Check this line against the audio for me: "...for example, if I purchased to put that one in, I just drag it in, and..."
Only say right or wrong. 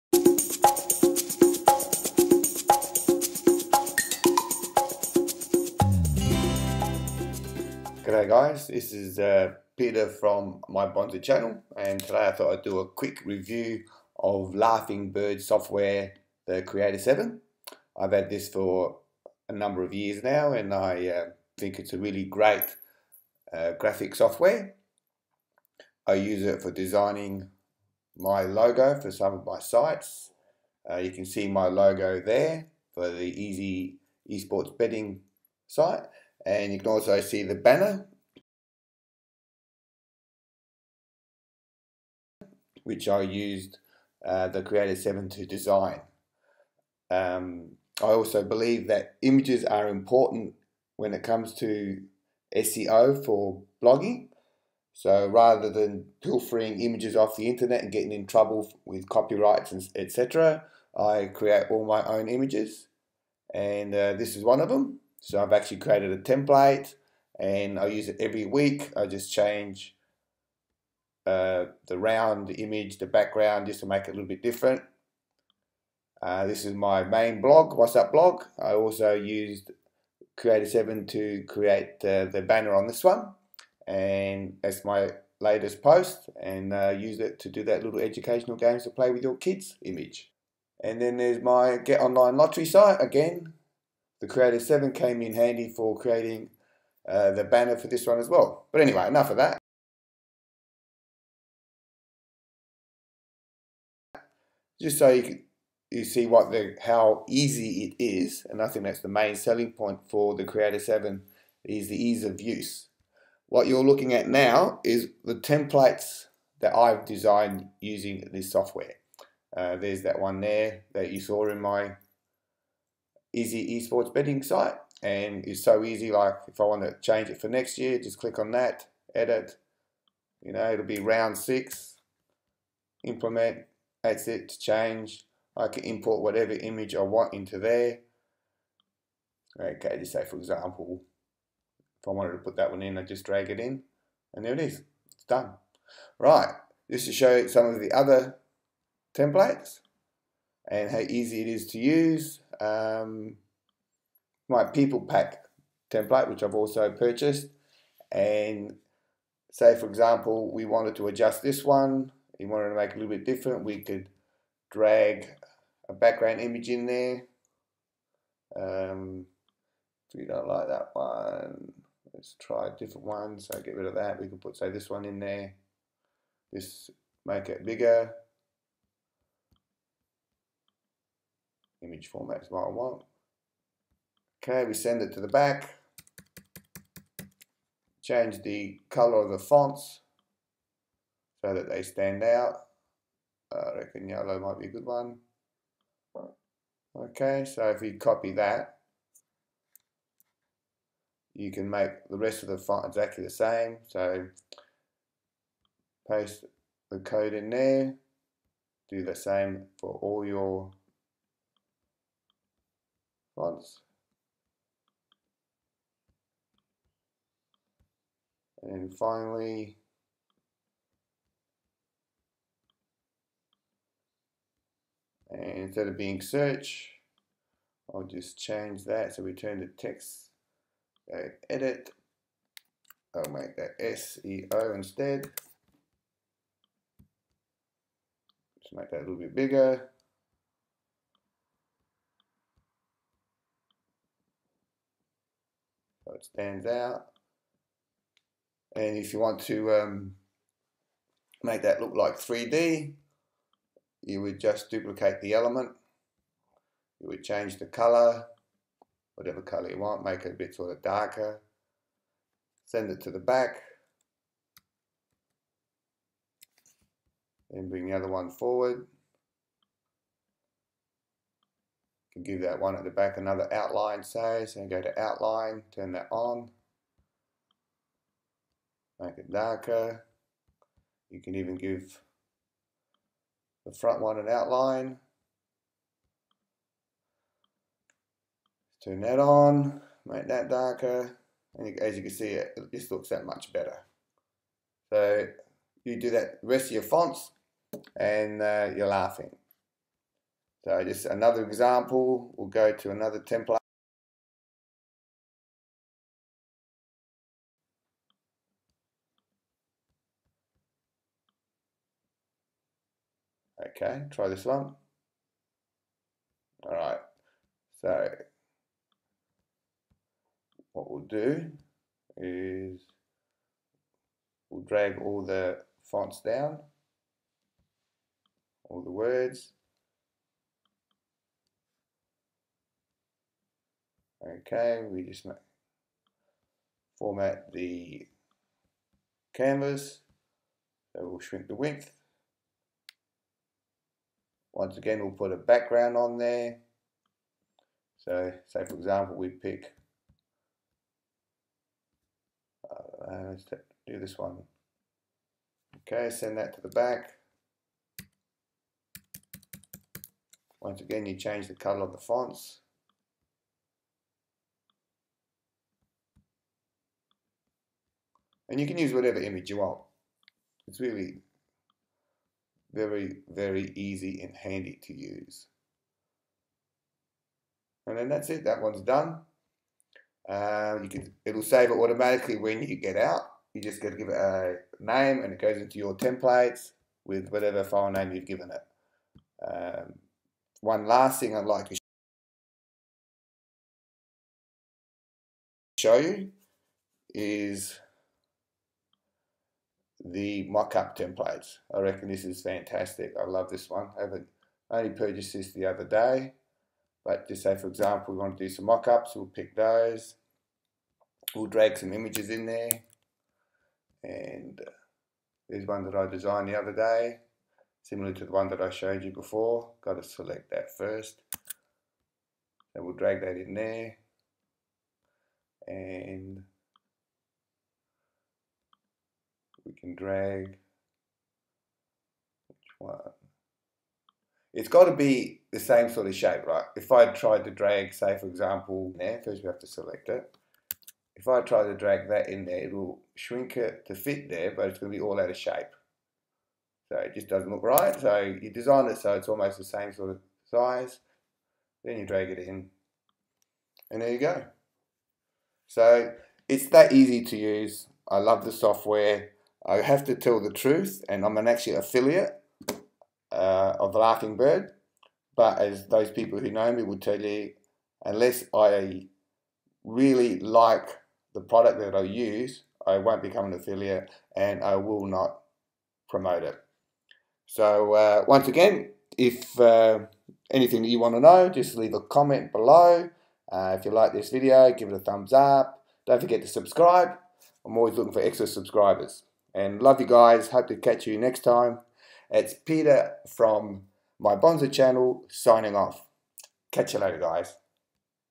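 wrong.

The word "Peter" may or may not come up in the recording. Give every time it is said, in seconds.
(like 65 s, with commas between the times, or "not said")
9 s, 492 s.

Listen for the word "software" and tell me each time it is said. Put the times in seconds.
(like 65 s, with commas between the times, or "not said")
15 s, 24 s, 118 s, 458 s.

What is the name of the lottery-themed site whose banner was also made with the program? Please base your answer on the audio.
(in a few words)
Get Online Lottery.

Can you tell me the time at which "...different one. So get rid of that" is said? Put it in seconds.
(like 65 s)
172 s.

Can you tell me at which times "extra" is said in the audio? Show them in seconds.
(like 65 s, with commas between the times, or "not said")
488 s.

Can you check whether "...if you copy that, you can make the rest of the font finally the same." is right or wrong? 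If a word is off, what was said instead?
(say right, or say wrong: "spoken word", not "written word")
wrong: "exactly", not "finally".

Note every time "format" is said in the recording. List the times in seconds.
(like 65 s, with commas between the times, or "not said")
182 s, 336 s.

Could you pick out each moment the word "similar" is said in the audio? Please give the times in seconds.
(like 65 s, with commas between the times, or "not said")
417 s.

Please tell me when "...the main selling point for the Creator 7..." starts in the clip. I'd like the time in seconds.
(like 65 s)
109 s.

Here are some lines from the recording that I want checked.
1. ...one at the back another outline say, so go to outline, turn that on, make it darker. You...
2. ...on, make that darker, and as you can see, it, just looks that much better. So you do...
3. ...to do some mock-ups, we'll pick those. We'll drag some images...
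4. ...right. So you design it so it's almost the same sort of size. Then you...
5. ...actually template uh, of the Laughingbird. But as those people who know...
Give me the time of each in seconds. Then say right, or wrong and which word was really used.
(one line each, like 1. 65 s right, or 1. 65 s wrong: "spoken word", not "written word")
1. 272 s right
2. 289 s right
3. 408 s right
4. 447 s right
5. 461 s wrong: "affiliate", not "template".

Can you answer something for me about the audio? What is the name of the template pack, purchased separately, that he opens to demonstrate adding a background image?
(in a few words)
people pack.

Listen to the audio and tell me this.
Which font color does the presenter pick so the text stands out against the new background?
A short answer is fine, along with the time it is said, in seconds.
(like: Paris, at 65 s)
yellow, at 194 s.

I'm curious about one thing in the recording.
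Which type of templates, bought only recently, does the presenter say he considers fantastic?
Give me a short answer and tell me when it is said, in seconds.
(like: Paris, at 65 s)
mock-up templates, at 400 s.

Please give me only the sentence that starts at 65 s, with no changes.
So I've actually created a template, and I use it every week.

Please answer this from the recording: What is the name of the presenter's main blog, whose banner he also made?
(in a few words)
WhatsApp blog.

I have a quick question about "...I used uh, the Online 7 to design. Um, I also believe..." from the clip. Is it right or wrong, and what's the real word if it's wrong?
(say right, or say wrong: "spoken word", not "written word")
wrong: "Creator", not "Online".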